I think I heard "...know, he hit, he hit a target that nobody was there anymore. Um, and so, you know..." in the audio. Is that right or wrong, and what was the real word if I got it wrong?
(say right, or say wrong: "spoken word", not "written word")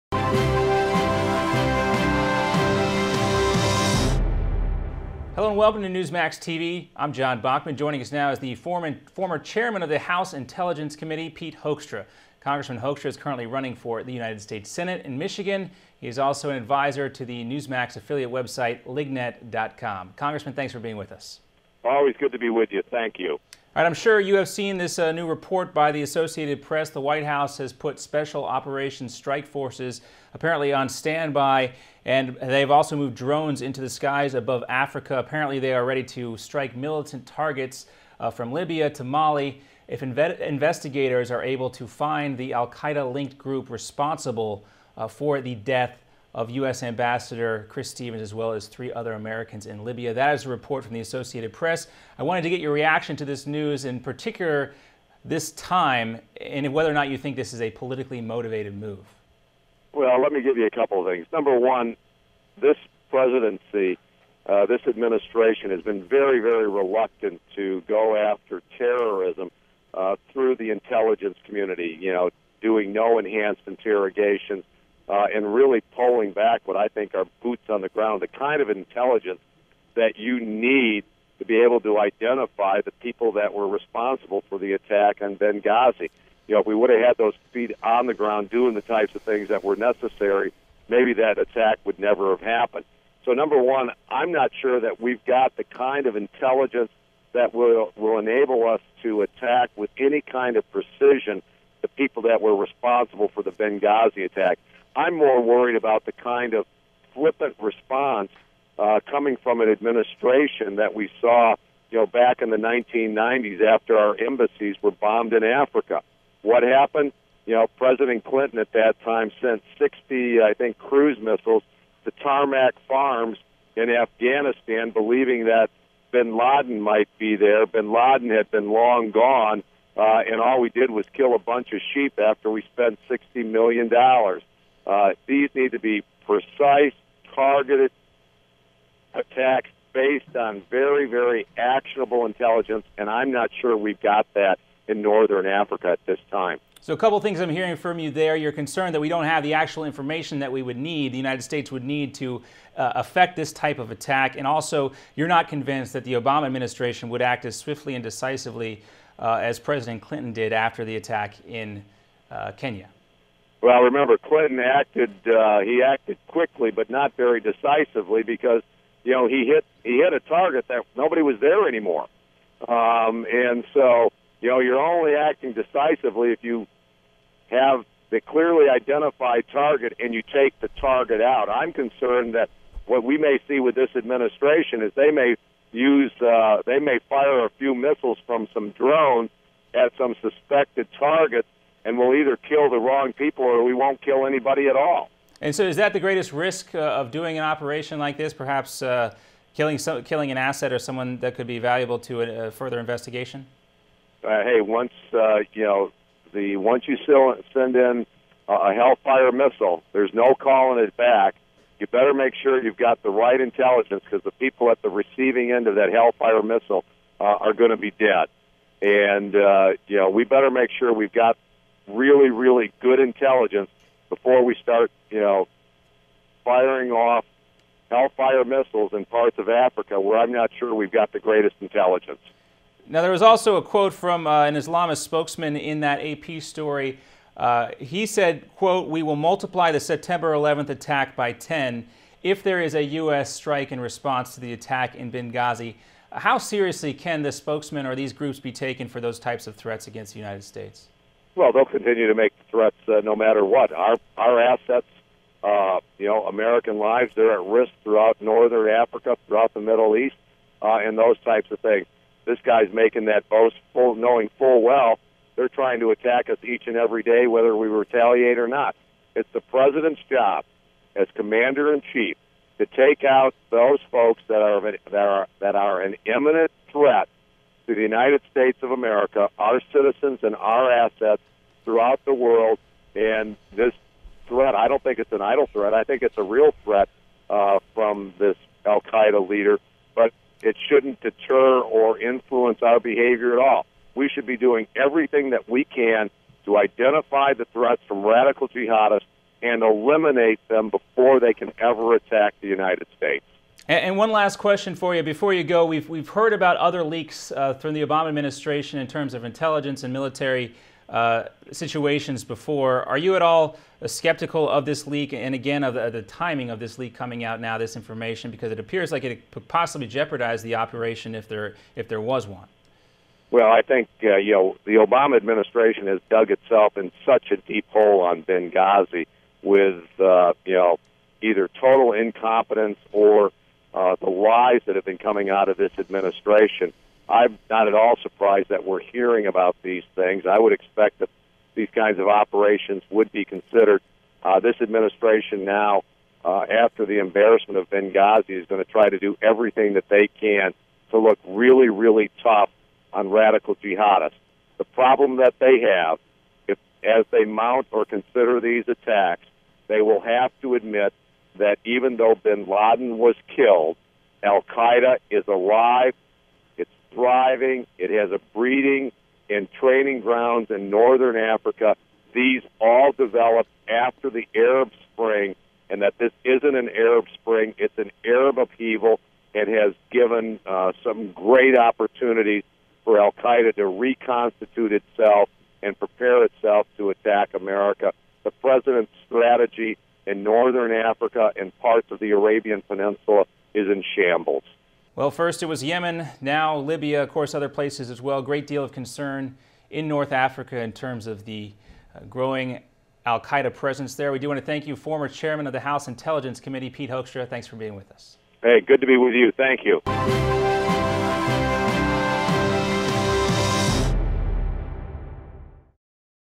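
right.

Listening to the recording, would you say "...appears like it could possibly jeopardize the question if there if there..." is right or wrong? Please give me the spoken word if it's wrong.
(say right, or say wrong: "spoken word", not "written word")
wrong: "operation", not "question".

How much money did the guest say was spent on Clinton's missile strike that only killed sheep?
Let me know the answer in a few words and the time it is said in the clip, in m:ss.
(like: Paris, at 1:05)
$60 million, at 2:13.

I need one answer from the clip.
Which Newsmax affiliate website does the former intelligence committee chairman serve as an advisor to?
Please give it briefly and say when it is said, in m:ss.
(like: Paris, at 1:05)
lignet.com, at 0:18.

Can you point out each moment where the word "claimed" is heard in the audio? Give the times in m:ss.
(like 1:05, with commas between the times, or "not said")
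not said.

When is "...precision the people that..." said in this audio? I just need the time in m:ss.
1:40.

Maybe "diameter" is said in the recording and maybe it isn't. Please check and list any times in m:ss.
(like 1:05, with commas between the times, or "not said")
not said.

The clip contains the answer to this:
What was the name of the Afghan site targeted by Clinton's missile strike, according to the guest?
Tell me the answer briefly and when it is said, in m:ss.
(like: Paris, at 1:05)
Tarnak Farms, at 2:02.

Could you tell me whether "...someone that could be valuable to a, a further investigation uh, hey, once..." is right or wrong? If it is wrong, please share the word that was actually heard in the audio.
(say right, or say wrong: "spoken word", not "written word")
right.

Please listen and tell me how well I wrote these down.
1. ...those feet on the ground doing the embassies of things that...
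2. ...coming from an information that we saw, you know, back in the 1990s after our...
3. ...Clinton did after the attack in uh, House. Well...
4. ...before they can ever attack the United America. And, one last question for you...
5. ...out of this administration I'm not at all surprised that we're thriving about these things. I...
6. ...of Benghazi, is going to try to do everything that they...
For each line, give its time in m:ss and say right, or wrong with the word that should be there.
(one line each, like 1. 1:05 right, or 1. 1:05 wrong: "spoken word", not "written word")
1. 1:27 wrong: "types", not "embassies"
2. 1:49 wrong: "administration", not "information"
3. 2:40 wrong: "Kenya", not "House"
4. 5:00 wrong: "States", not "America"
5. 5:35 wrong: "hearing", not "thriving"
6. 5:47 right.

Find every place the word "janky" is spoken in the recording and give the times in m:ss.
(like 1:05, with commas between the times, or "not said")
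not said.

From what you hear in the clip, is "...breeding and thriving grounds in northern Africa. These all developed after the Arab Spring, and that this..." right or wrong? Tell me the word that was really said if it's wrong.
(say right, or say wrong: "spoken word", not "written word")
wrong: "training", not "thriving".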